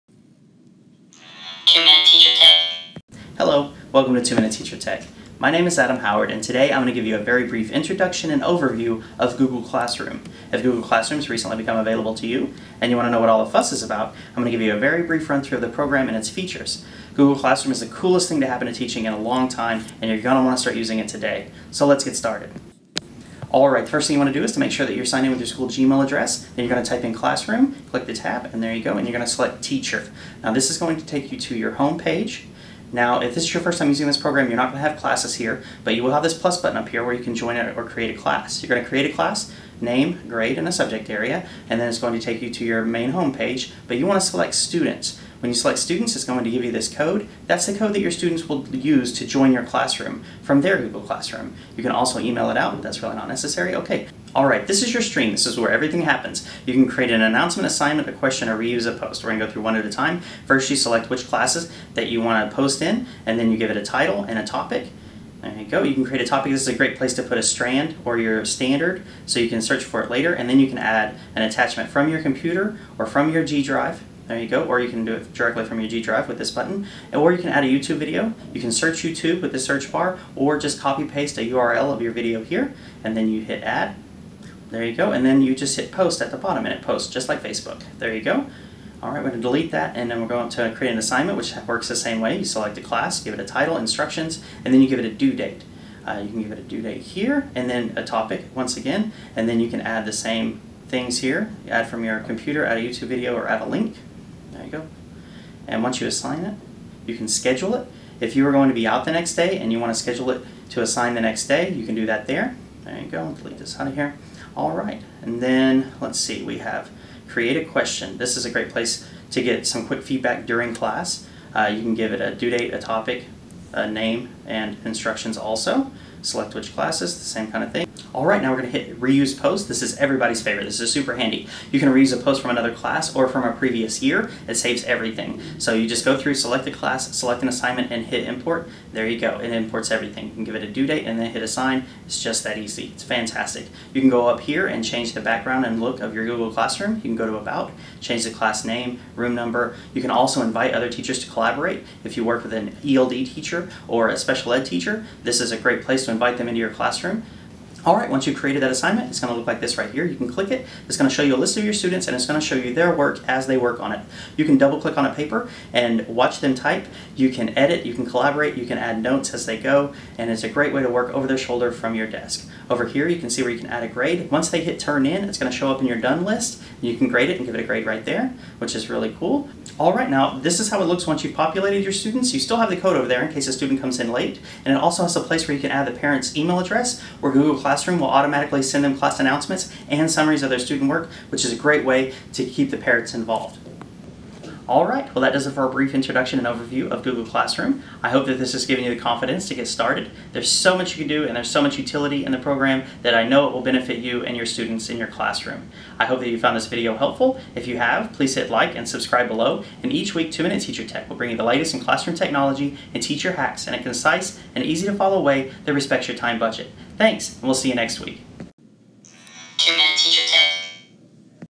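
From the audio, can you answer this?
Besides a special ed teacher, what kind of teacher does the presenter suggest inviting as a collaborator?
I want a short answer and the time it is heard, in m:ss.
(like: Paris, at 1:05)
ELD teacher, at 2:32.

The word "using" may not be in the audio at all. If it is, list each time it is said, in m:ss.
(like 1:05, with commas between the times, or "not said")
0:20, 0:33.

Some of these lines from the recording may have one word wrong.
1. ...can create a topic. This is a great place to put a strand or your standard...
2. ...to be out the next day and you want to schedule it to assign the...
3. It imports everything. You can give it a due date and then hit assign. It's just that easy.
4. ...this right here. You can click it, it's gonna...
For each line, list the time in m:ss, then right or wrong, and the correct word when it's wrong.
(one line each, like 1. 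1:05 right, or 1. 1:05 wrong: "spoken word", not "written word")
1. 1:05 right
2. 1:48 right
3. 2:19 right
4. 2:39 right.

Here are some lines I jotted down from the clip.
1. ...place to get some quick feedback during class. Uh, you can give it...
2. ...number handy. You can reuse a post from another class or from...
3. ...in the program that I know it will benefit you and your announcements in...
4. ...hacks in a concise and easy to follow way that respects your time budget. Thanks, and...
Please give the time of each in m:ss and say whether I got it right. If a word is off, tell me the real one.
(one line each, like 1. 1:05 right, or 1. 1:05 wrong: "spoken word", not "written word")
1. 1:58 right
2. 2:10 wrong: "super", not "number"
3. 3:22 wrong: "students", not "announcements"
4. 3:33 right.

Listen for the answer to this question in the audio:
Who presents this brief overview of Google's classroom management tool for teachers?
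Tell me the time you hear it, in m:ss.
0:05.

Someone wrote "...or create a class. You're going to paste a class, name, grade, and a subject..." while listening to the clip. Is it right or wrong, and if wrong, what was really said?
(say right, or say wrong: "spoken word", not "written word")
wrong: "create", not "paste".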